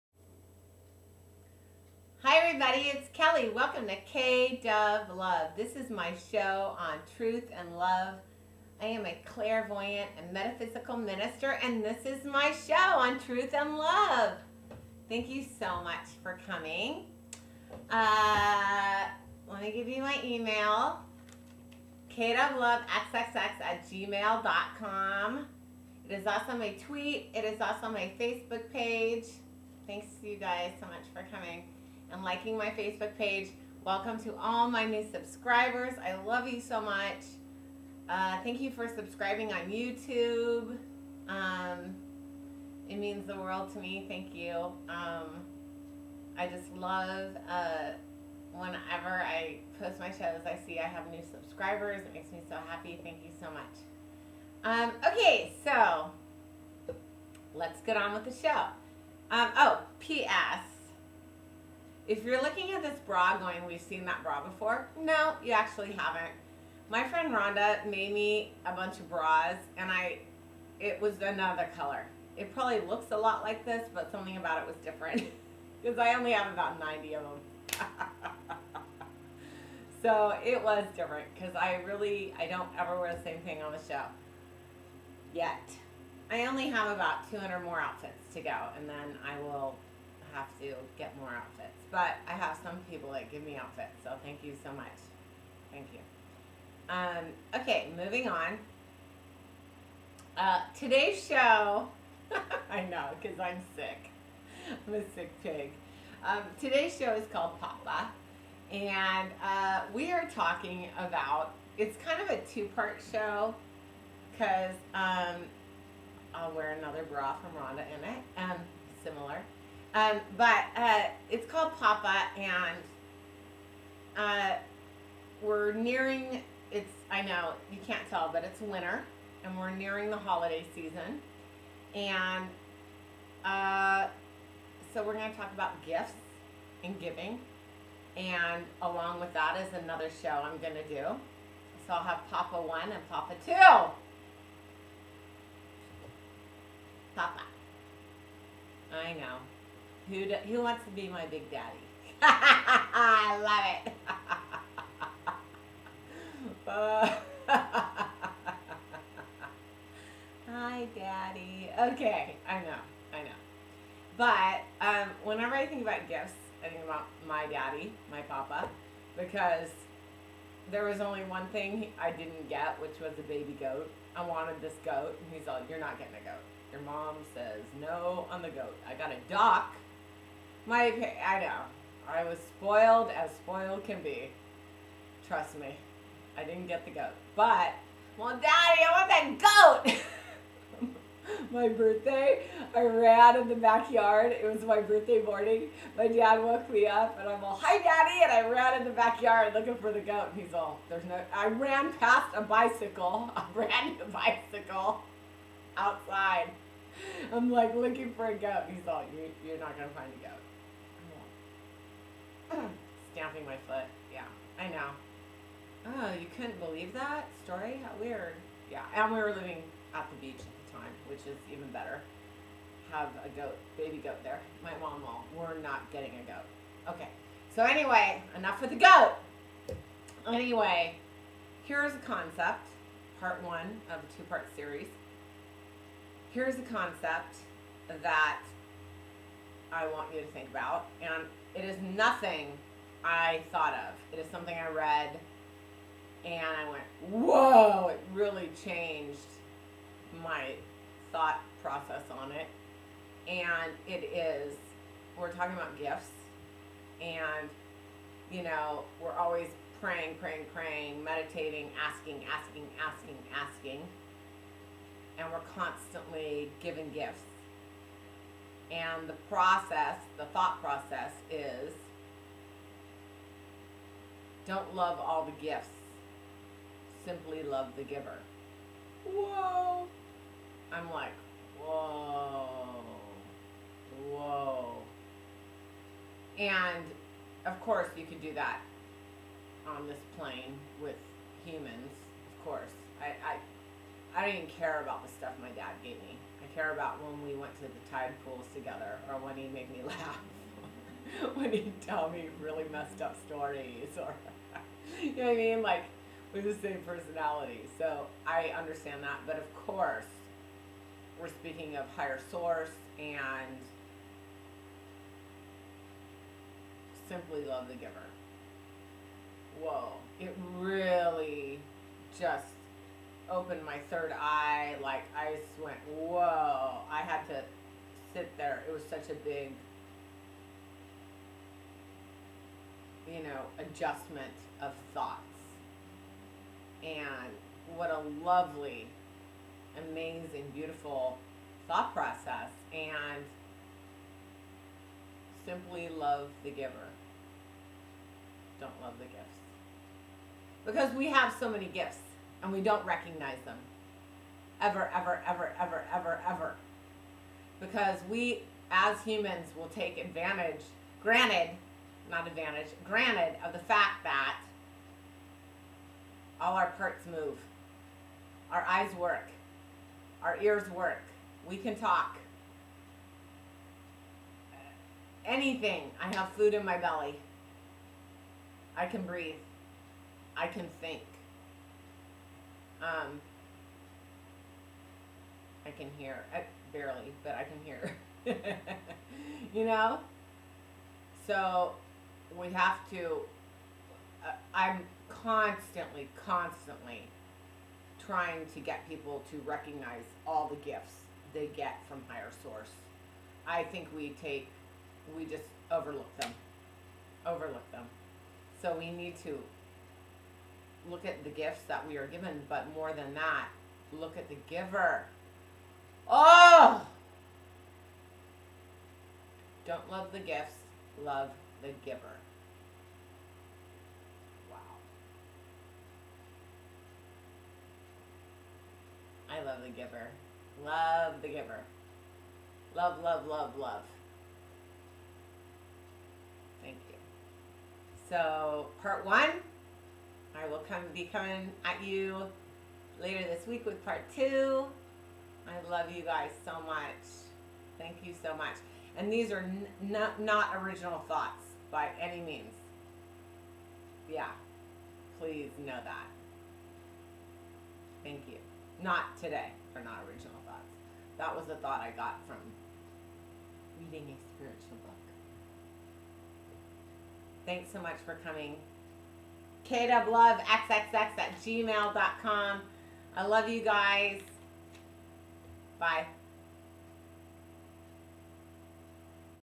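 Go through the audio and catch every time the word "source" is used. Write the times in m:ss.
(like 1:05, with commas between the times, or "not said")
5:12, 6:42.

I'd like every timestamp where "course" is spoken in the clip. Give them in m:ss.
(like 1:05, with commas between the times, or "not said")
4:47, 4:52, 5:09.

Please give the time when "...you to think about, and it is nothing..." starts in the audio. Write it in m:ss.
4:00.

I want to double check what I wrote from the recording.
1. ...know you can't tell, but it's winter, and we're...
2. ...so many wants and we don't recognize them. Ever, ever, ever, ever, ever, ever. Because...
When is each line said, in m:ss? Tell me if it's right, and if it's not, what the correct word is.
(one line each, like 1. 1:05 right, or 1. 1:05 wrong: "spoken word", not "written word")
1. 2:07 right
2. 5:51 wrong: "gifts", not "wants".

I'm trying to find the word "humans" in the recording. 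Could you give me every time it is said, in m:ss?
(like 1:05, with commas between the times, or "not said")
4:51, 5:59.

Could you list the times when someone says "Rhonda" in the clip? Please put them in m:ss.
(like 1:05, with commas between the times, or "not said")
1:07, 1:57.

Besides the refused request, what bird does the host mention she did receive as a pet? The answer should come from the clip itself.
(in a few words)
A duck.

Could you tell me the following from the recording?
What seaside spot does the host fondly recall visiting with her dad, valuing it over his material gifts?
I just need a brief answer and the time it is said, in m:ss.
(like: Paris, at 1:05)
The tide pools, at 4:57.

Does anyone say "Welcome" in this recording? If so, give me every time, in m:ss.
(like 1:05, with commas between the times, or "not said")
0:03, 0:33.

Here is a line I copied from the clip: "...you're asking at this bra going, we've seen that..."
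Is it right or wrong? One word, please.
wrong.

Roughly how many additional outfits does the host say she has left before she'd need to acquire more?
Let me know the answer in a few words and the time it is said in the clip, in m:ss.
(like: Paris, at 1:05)
200, at 1:27.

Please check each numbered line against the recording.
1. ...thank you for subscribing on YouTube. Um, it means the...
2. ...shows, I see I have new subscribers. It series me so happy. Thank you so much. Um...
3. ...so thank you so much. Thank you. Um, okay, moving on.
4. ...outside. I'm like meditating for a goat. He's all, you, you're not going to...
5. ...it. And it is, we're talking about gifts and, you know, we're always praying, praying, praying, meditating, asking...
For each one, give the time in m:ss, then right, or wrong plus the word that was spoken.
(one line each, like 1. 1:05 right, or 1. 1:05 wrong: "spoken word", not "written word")
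1. 0:38 right
2. 0:50 wrong: "makes", not "series"
3. 1:34 right
4. 3:25 wrong: "looking", not "meditating"
5. 4:12 right.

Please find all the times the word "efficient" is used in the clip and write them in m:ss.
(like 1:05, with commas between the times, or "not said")
not said.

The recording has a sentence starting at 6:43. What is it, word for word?
I think we take, we just overlook them, overlook them.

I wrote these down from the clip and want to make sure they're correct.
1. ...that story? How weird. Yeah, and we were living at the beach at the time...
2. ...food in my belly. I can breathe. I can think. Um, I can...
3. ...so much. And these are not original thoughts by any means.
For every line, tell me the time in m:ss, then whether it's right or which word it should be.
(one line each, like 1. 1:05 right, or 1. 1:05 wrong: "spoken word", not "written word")
1. 3:36 right
2. 6:16 right
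3. 7:28 right.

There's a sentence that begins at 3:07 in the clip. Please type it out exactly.
But, well, Daddy, I want that goat!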